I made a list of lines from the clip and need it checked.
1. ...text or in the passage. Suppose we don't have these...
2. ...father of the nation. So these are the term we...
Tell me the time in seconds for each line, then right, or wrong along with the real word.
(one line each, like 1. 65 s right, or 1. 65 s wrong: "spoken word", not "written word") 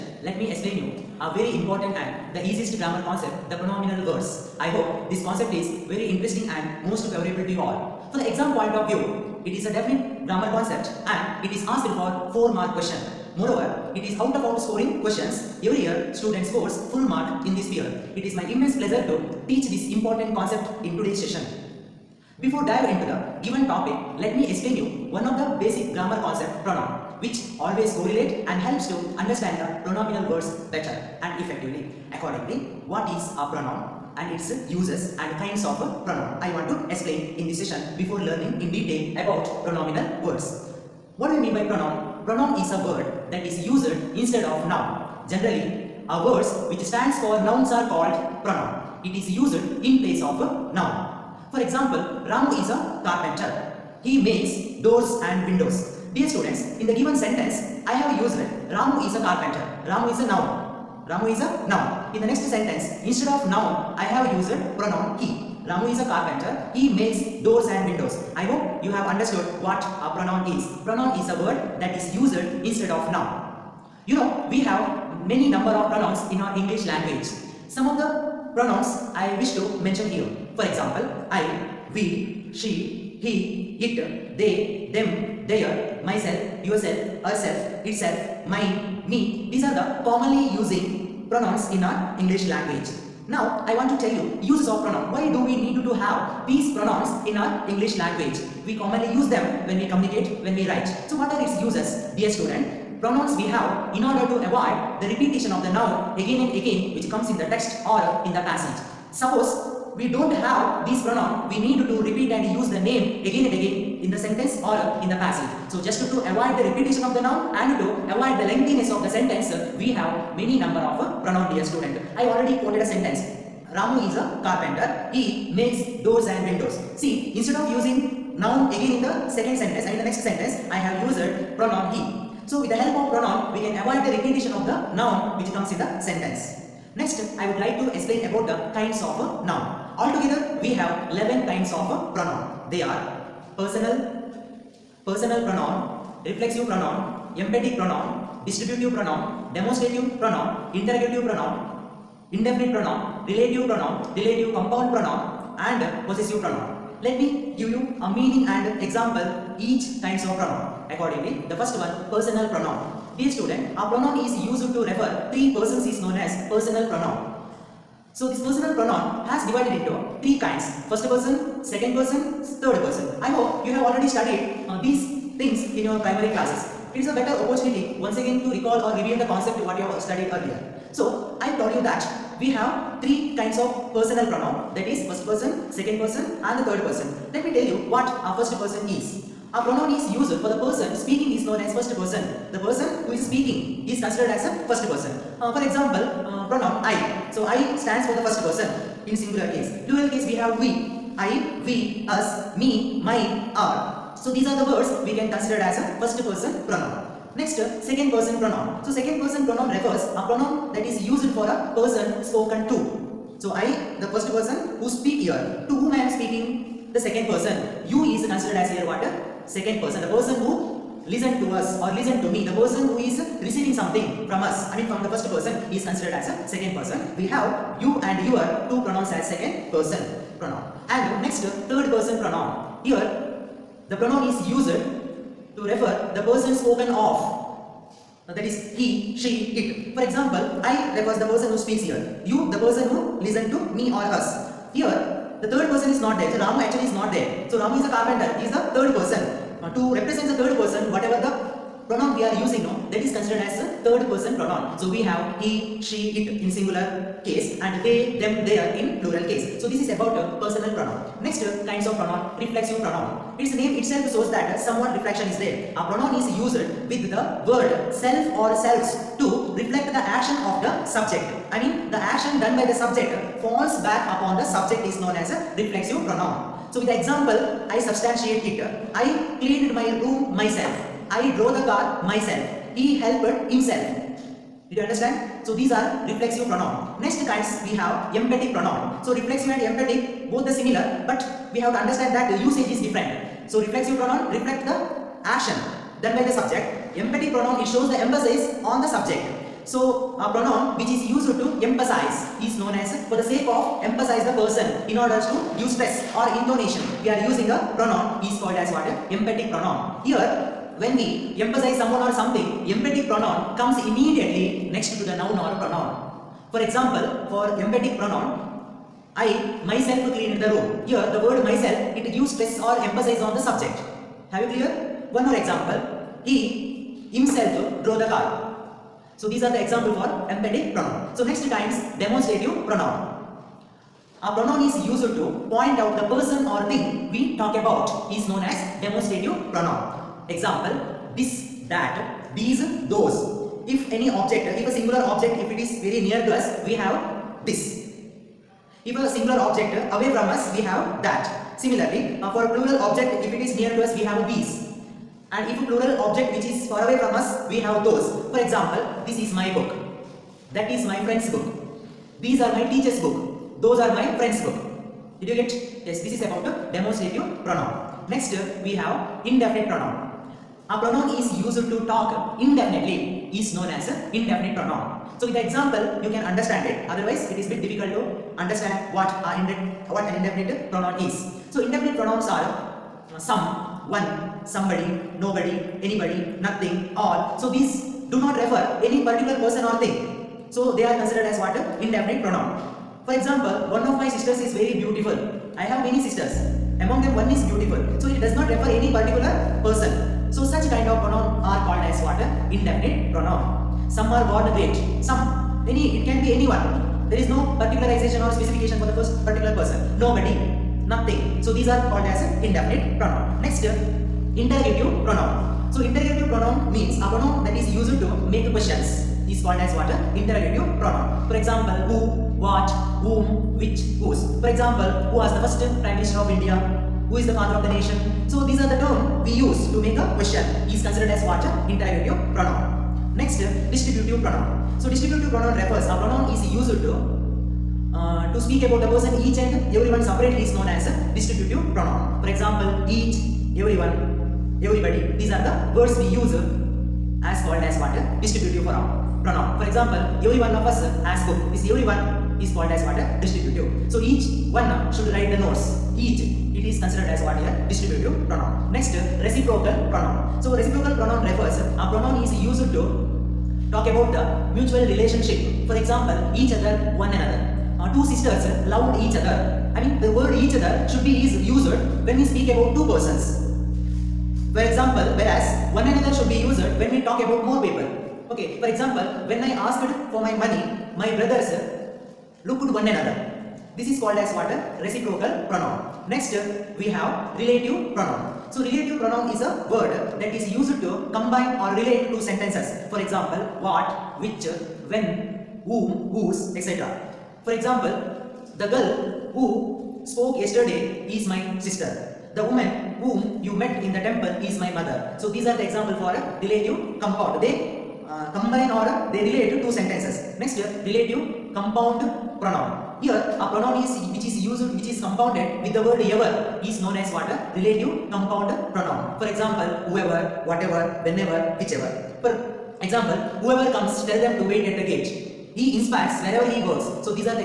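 1. 107 s right
2. 427 s right.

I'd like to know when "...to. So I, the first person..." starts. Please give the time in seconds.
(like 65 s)
212 s.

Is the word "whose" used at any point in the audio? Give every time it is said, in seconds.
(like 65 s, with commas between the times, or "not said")
423 s, 496 s.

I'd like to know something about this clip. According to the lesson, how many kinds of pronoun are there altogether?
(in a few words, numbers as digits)
11.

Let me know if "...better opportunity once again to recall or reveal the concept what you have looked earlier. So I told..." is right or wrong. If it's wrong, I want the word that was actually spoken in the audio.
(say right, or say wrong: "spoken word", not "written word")
wrong: "studied", not "looked".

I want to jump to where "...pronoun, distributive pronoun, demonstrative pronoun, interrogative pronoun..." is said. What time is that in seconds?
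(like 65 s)
147 s.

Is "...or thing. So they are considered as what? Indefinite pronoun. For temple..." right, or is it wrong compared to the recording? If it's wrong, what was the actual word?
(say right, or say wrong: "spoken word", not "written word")
wrong: "example", not "temple".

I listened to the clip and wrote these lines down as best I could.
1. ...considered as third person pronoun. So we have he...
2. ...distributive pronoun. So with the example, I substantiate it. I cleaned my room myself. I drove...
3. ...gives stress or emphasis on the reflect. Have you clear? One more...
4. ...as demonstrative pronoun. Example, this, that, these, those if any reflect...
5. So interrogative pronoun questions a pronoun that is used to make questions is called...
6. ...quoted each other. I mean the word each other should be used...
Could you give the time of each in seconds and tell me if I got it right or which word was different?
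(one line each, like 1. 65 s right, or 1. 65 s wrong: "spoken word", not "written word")
1. 253 s right
2. 275 s wrong: "reflexive", not "distributive"
3. 322 s wrong: "subject", not "reflect"
4. 338 s wrong: "object", not "reflect"
5. 415 s wrong: "means", not "questions"
6. 468 s wrong: "loved", not "quoted".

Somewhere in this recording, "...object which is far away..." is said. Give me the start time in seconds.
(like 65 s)
356 s.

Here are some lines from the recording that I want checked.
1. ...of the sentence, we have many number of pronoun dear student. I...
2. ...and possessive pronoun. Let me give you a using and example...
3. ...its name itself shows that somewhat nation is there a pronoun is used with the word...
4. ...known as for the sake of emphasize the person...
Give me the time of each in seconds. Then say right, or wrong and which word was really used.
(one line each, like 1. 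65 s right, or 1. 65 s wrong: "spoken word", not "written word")
1. 118 s right
2. 155 s wrong: "meaning", not "using"
3. 263 s wrong: "reflection", not "nation"
4. 302 s right.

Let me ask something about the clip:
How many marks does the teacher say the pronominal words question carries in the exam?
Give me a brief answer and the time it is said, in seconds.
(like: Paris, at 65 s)
4, at 12 s.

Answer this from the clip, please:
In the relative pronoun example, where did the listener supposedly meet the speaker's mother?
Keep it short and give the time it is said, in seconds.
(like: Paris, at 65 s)
temple, at 504 s.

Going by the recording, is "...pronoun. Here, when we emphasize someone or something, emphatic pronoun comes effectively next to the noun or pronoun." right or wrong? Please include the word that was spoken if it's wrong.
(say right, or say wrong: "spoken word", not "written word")
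wrong: "immediately", not "effectively".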